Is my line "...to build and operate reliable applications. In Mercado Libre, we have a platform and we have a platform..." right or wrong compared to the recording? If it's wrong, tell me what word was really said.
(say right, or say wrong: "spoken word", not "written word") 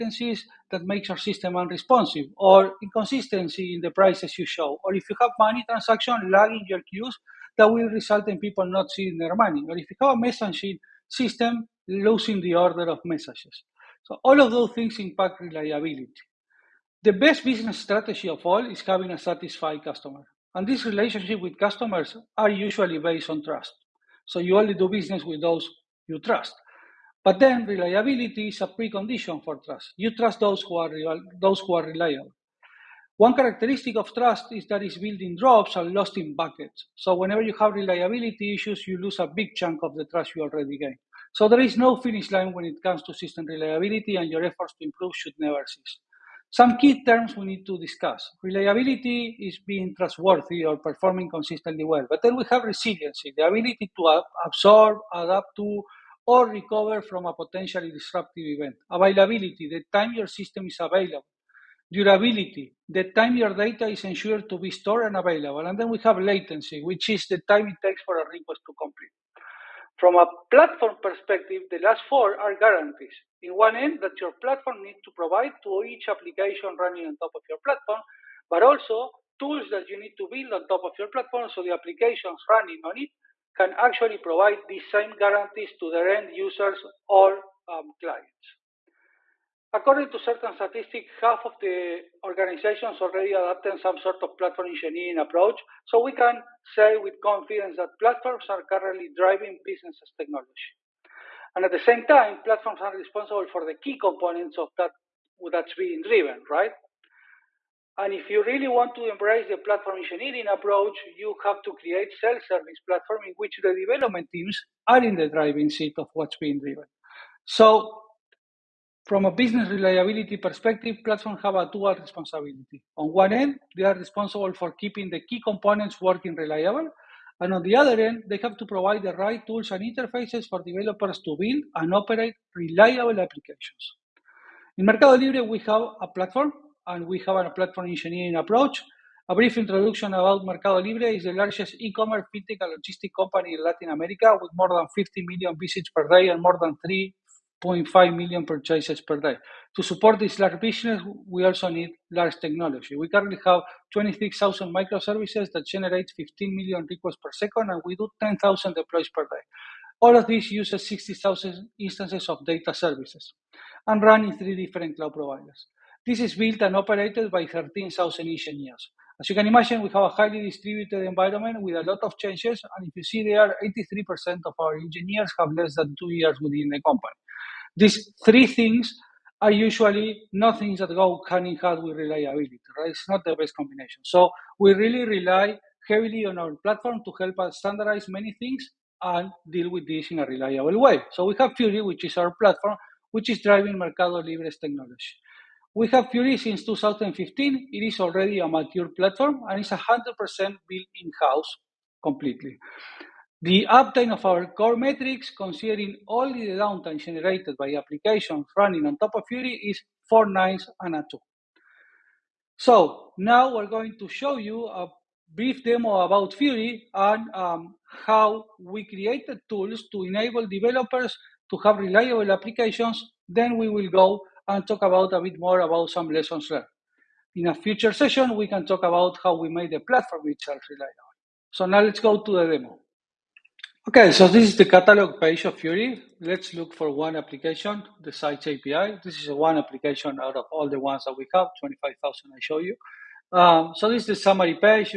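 right.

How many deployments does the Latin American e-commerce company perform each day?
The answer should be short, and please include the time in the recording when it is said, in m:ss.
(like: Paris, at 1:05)
10,000, at 2:38.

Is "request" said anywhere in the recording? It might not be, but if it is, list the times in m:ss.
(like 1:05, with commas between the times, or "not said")
1:08, 2:36.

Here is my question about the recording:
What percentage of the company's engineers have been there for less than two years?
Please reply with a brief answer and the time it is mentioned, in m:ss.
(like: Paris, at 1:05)
83%, at 2:53.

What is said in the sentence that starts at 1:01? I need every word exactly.
Durability, the time your data is ensured to be stored and available.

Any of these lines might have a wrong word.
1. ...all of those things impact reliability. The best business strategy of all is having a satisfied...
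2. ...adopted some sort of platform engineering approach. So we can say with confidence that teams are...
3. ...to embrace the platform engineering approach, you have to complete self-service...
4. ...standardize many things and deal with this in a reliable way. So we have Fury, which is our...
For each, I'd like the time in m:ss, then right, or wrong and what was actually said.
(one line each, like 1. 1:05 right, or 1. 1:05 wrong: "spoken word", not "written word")
1. 0:14 right
2. 1:33 wrong: "platforms", not "teams"
3. 1:48 wrong: "create", not "complete"
4. 3:07 right.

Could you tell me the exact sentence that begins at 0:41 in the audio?
So there is no finish line when it comes to system reliability, and your efforts to improve should never cease.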